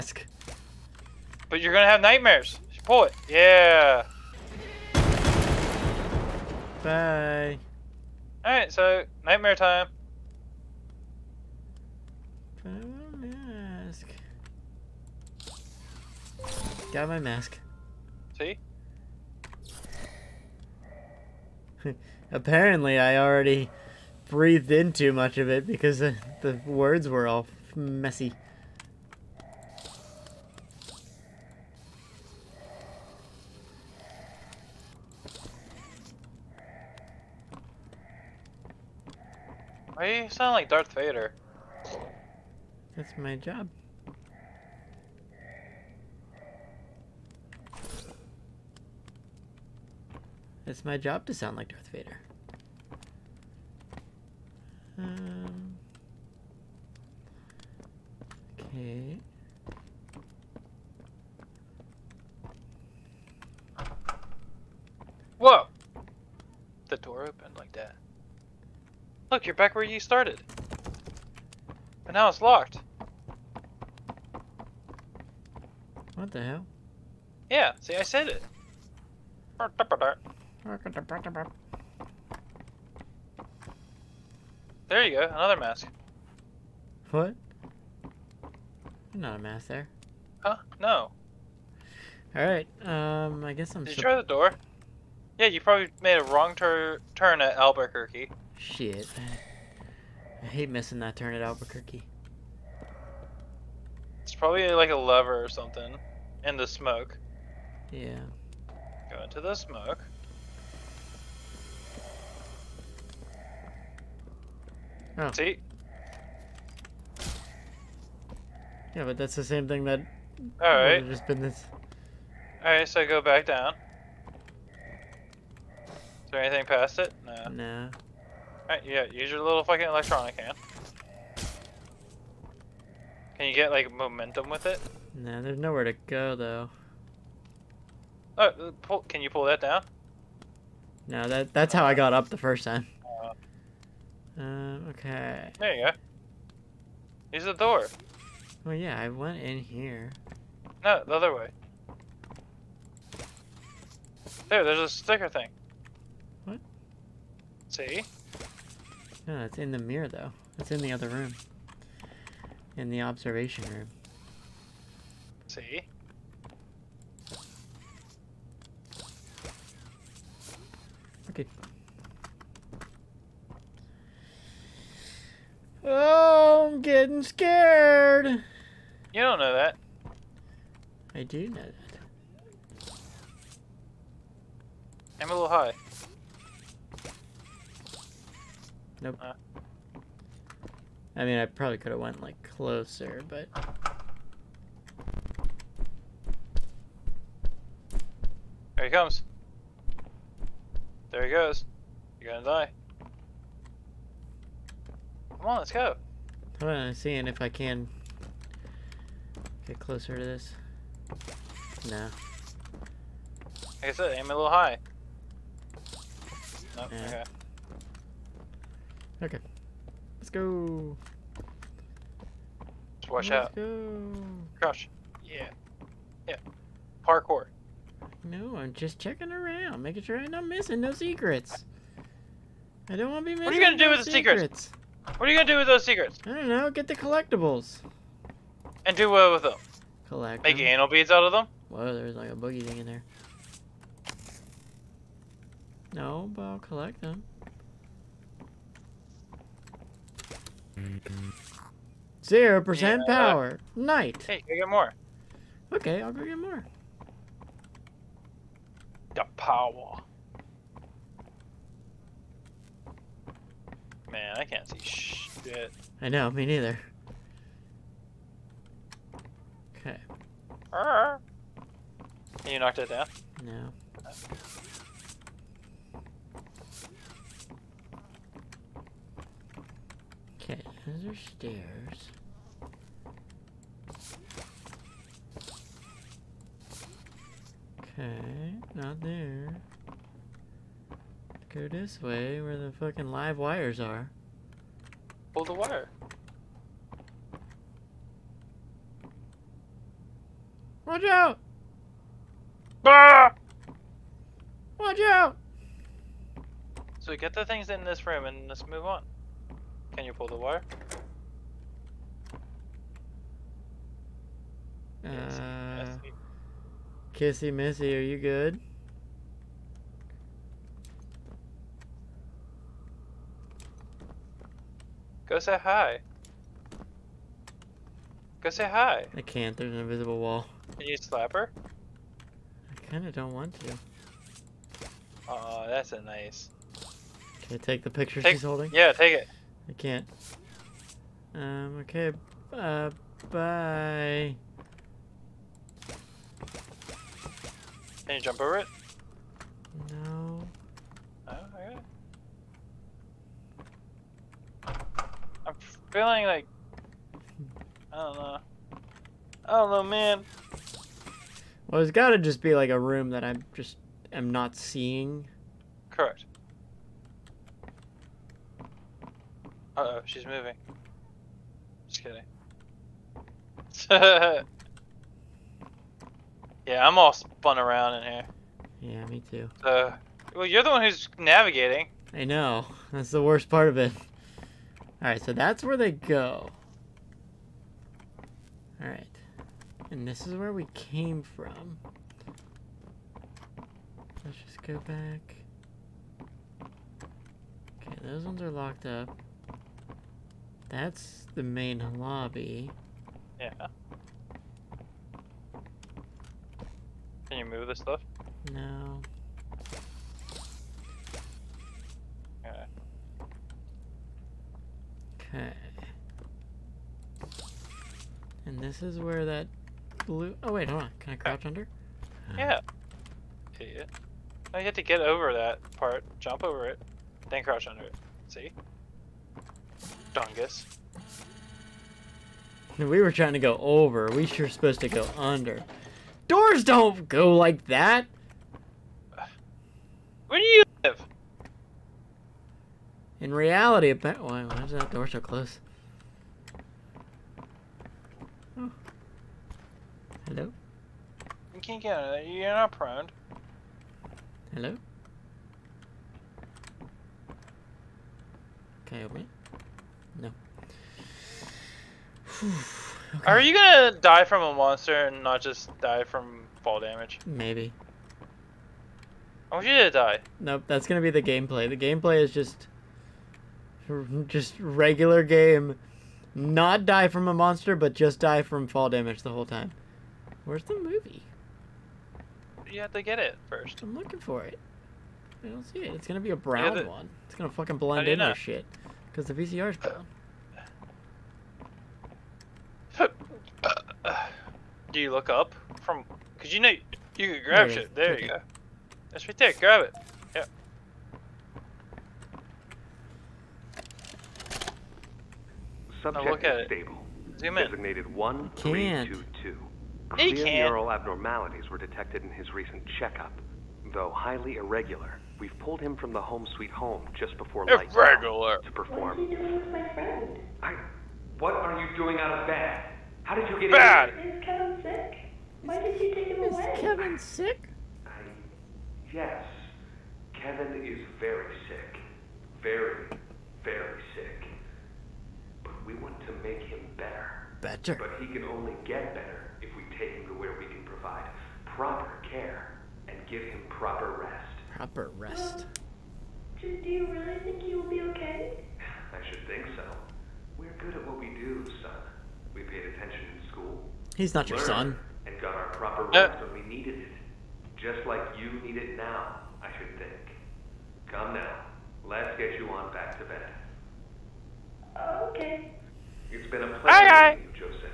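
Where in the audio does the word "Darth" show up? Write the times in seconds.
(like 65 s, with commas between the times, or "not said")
40 s, 51 s.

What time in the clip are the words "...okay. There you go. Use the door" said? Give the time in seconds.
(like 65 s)
144 s.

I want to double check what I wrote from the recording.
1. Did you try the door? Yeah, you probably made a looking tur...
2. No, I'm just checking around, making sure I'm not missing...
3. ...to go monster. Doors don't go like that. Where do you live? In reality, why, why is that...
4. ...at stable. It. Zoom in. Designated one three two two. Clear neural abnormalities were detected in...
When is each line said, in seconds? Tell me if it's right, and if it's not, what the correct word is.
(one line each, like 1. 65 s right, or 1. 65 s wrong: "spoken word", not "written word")
1. 93 s wrong: "wrong", not "looking"
2. 228 s right
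3. 434 s wrong: "under", not "monster"
4. 506 s right.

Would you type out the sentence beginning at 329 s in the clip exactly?
I can't, there's an invisible wall.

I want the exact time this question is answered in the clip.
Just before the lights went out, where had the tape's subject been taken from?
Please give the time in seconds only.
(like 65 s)
516 s.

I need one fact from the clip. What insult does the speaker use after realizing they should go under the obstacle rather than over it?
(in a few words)
Dungus.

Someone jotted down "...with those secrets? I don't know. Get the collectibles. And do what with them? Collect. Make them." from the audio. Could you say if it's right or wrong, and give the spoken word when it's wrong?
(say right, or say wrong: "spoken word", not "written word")
right.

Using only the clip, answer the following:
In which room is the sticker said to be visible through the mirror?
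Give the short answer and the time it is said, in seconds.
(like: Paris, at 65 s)
the observation room, at 163 s.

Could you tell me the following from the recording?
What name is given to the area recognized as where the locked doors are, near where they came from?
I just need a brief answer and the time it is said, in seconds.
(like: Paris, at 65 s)
main lobby, at 401 s.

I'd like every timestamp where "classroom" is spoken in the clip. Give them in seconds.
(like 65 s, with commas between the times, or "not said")
not said.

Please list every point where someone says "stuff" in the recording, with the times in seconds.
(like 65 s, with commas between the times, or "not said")
407 s.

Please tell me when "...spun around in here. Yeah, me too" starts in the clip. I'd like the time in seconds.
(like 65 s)
377 s.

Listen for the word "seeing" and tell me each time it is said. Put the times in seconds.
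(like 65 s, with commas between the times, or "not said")
206 s, 364 s.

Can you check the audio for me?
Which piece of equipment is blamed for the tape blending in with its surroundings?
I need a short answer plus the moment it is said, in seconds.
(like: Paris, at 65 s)
the VCR, at 489 s.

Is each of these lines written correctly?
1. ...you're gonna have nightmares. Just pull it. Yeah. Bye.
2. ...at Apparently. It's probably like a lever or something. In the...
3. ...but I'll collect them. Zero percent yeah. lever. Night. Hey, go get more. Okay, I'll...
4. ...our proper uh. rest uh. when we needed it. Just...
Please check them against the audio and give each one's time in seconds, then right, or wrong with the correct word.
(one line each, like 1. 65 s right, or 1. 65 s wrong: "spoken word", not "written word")
1. 1 s right
2. 101 s wrong: "Albuquerque", not "Apparently"
3. 246 s wrong: "power", not "lever"
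4. 555 s right.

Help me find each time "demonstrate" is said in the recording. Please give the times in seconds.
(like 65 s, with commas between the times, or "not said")
not said.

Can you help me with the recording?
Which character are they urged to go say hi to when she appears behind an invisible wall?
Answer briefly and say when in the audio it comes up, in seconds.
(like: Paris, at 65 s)
Kissy Missy, at 317 s.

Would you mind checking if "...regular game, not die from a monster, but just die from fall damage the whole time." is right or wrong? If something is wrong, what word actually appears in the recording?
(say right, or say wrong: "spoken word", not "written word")
right.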